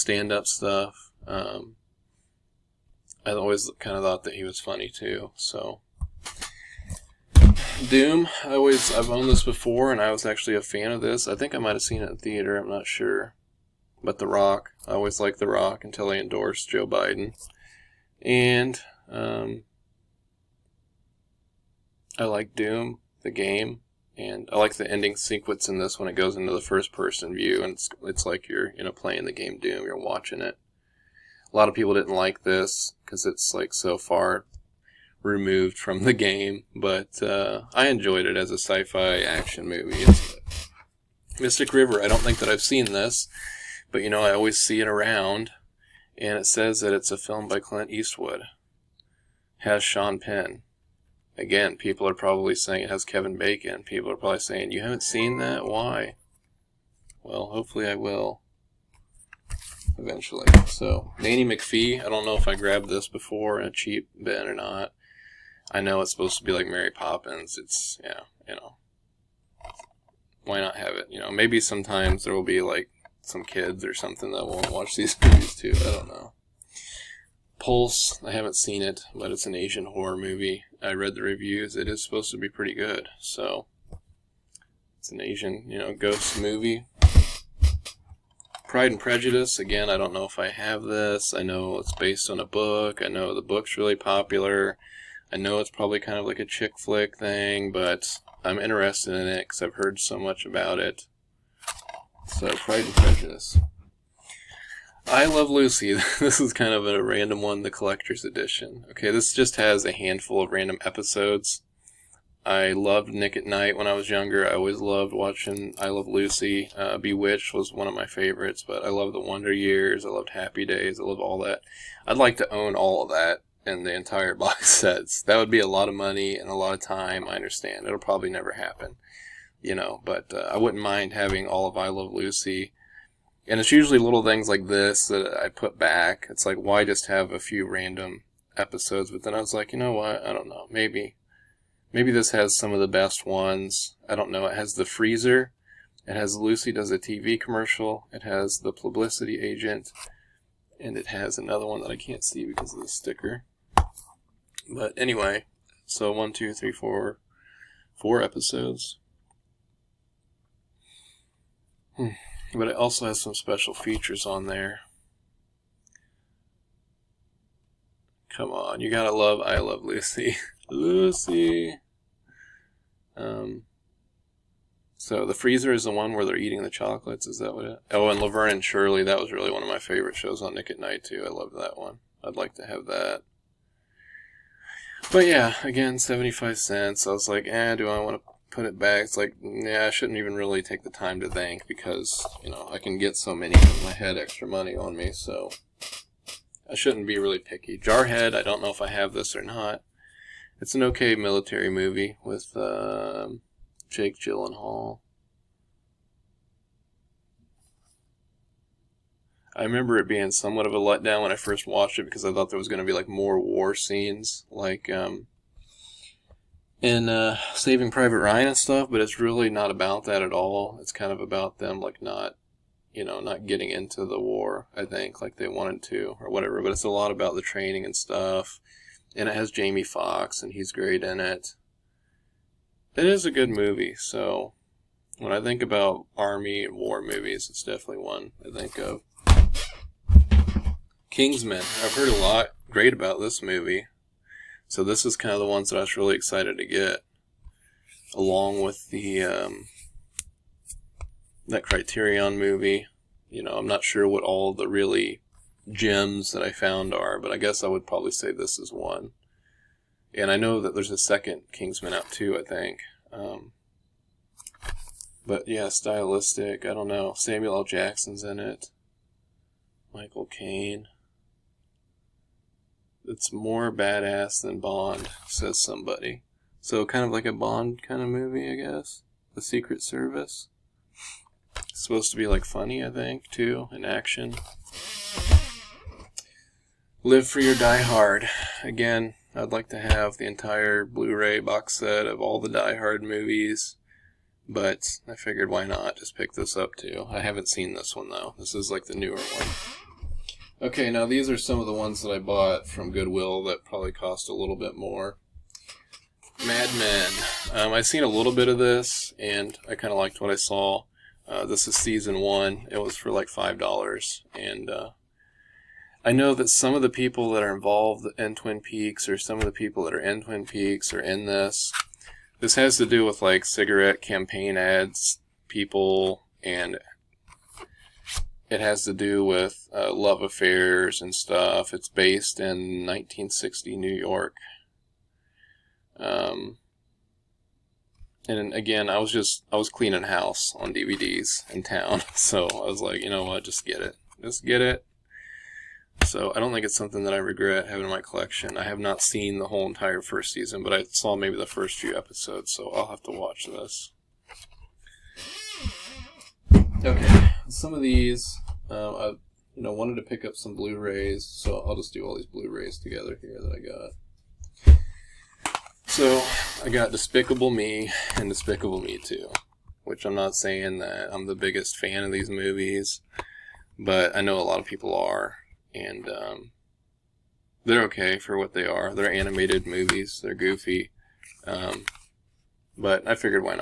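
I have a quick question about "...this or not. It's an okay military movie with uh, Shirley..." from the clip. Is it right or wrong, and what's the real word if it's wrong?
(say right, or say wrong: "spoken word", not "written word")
wrong: "Jake", not "Shirley".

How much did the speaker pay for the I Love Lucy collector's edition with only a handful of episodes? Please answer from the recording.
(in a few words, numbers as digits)
75 cents.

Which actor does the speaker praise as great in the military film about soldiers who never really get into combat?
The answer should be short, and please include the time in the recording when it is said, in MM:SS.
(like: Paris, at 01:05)
Jamie Foxx, at 03:49.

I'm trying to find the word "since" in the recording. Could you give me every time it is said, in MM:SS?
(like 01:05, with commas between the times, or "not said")
not said.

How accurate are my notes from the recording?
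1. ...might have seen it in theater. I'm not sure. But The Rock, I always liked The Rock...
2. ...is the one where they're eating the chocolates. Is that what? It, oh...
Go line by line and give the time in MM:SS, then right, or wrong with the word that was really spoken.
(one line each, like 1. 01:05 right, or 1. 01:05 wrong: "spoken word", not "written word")
1. 00:11 right
2. 02:55 right.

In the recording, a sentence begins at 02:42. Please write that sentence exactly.
But it also has some special features on there.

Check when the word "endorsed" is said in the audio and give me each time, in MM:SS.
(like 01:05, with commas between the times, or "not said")
00:16.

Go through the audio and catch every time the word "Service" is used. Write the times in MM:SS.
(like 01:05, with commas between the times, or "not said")
04:39.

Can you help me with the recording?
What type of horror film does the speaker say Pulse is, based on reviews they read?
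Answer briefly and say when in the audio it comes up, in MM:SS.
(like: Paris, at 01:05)
Asian horror movie, at 01:19.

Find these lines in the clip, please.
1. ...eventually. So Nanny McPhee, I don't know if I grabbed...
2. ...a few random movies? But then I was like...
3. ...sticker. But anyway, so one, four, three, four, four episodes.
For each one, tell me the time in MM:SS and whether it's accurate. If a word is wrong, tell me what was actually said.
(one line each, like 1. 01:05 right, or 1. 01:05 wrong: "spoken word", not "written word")
1. 00:59 right
2. 02:17 wrong: "episodes", not "movies"
3. 02:32 wrong: "two", not "four".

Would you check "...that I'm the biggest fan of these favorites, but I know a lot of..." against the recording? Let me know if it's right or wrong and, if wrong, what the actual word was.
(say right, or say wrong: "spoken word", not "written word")
wrong: "movies", not "favorites".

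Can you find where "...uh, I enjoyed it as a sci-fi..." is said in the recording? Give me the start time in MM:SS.
00:37.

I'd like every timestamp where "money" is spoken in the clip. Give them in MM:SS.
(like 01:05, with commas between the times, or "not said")
02:05, 03:14.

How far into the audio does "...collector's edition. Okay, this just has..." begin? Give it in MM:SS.
01:47.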